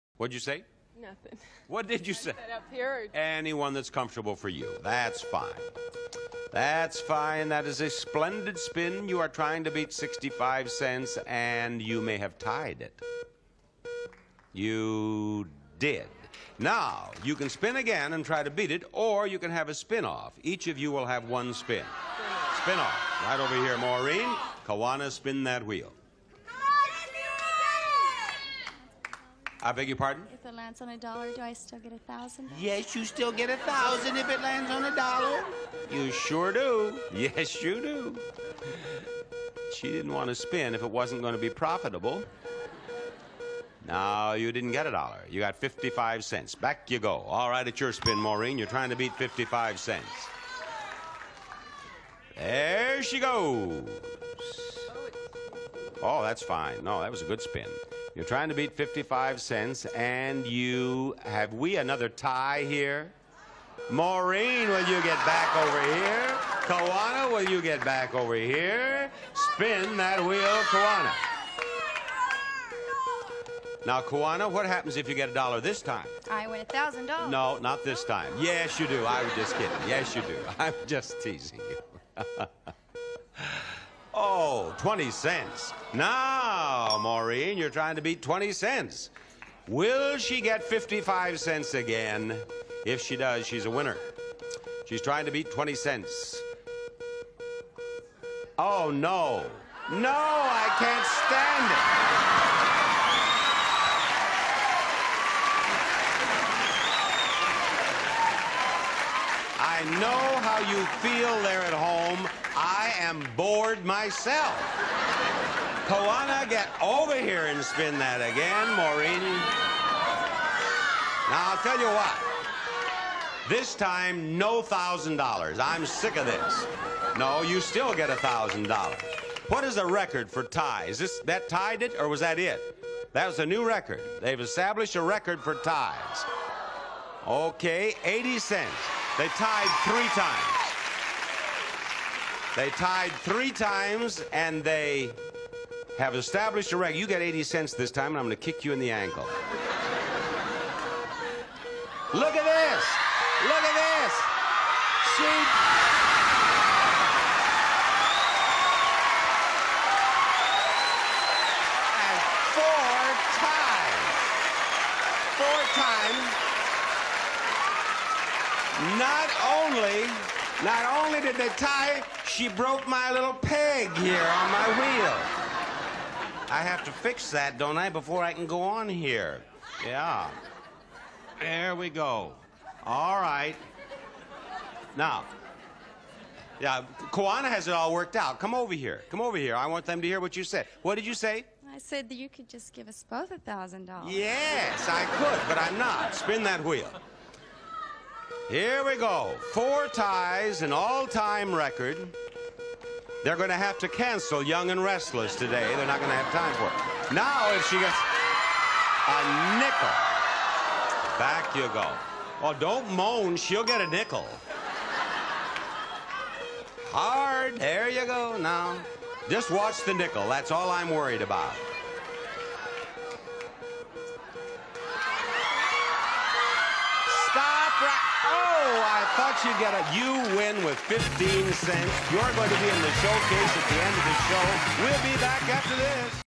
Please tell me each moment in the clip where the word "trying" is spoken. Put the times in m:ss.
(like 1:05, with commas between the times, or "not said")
0:09, 0:48, 0:58, 1:27, 1:35.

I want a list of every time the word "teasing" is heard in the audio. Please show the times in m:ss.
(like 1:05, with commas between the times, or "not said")
1:21.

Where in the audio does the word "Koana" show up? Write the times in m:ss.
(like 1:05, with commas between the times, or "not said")
1:55, 3:07.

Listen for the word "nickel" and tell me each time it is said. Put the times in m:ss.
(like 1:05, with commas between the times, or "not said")
3:29, 3:33, 3:39.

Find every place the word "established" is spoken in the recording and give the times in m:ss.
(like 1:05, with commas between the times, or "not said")
2:14, 2:26.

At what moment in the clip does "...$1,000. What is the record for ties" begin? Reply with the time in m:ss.
2:08.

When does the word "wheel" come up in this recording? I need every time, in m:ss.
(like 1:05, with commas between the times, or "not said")
0:25, 1:10, 2:54, 3:16.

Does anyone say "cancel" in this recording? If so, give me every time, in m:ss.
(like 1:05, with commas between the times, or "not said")
3:23.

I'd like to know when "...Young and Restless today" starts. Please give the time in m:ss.
3:24.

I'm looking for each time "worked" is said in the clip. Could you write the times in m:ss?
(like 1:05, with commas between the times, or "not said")
3:07.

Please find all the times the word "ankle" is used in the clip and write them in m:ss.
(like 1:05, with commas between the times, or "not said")
2:28.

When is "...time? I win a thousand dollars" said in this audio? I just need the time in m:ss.
1:15.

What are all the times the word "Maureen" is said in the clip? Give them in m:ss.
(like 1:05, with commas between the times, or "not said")
0:23, 0:48, 1:03, 1:27, 1:58.